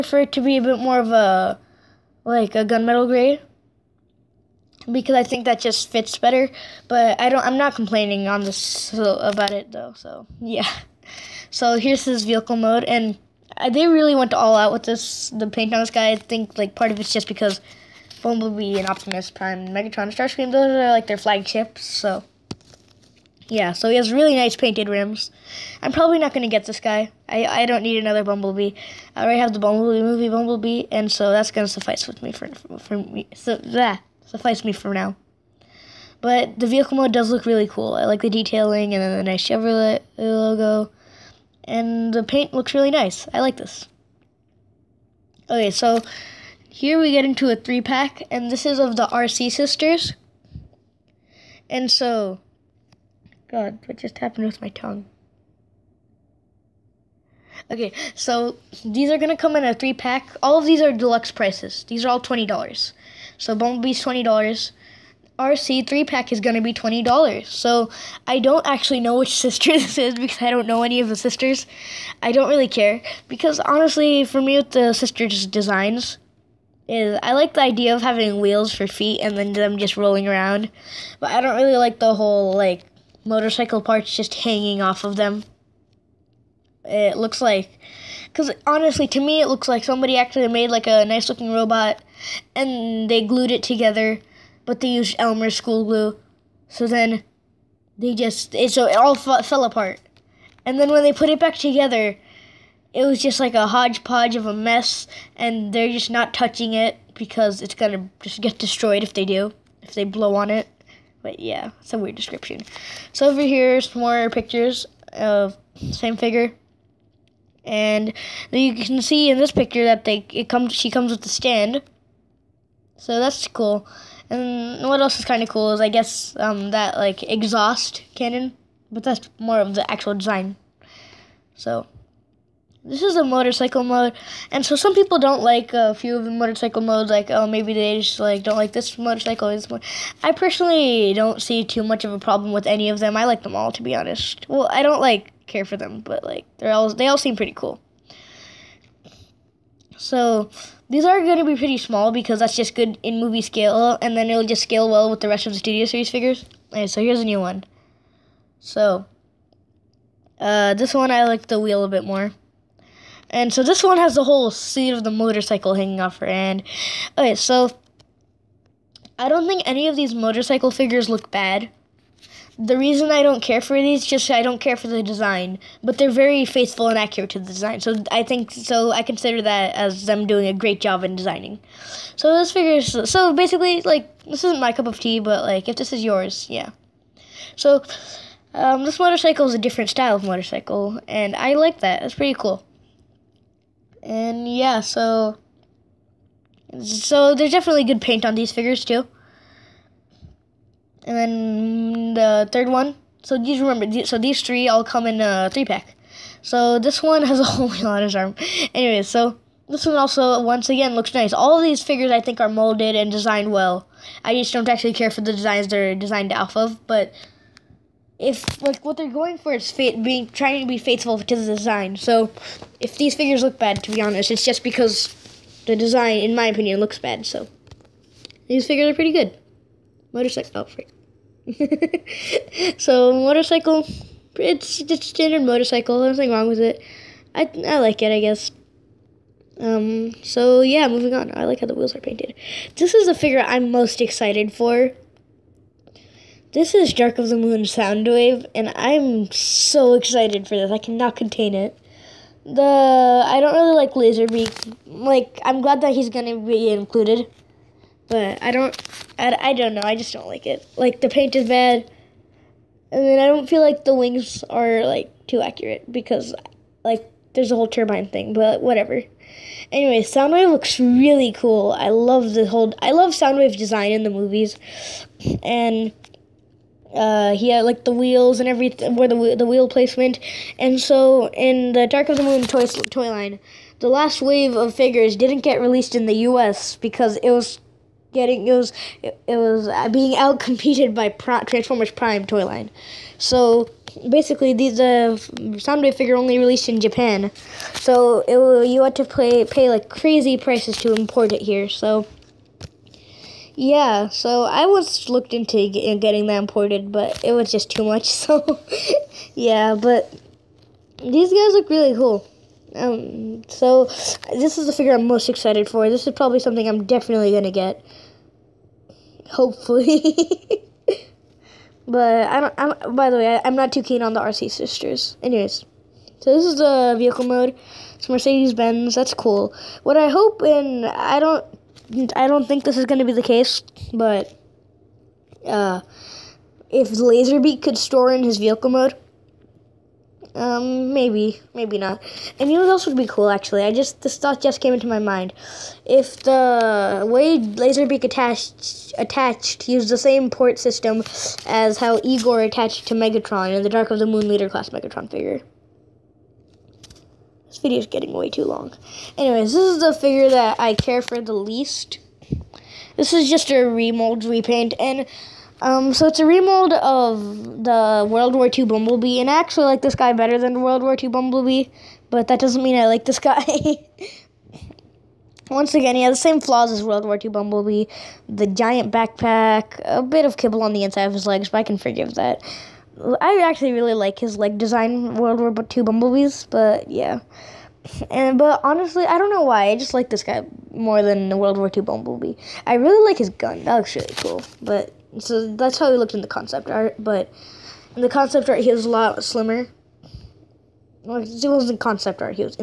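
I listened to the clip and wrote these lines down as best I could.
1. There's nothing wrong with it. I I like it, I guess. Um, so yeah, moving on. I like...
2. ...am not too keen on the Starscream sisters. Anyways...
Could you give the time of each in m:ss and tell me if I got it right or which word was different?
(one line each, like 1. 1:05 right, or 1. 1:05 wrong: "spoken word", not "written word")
1. 3:56 right
2. 5:23 wrong: "Arcee", not "Starscream".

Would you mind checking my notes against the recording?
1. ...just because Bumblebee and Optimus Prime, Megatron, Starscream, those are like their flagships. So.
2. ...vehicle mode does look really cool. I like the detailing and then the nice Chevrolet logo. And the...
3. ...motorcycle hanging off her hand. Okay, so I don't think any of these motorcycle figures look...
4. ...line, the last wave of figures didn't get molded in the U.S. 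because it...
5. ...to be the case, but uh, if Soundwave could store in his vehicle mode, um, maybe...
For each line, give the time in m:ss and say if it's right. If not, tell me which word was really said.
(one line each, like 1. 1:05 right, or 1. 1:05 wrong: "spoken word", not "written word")
1. 0:17 right
2. 0:36 right
3. 2:45 right
4. 4:43 wrong: "released", not "molded"
5. 5:32 wrong: "Laserbeak", not "Soundwave".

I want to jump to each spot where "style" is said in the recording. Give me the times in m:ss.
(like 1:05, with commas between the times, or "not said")
3:09.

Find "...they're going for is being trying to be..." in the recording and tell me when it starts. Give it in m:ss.
3:38.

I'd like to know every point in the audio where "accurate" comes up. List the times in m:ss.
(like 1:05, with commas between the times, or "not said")
2:56, 4:25.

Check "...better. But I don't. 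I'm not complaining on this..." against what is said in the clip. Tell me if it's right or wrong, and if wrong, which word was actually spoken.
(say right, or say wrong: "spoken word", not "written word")
right.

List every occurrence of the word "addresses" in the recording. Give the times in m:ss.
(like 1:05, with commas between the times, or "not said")
not said.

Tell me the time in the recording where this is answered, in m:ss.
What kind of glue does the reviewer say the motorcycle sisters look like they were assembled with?
1:35.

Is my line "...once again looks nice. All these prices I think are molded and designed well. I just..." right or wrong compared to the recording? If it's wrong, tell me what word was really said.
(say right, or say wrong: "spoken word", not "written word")
wrong: "figures", not "prices".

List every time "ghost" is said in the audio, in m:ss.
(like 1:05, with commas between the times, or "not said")
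not said.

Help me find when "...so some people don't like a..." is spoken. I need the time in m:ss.
2:14.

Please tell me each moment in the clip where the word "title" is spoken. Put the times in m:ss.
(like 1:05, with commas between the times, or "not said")
not said.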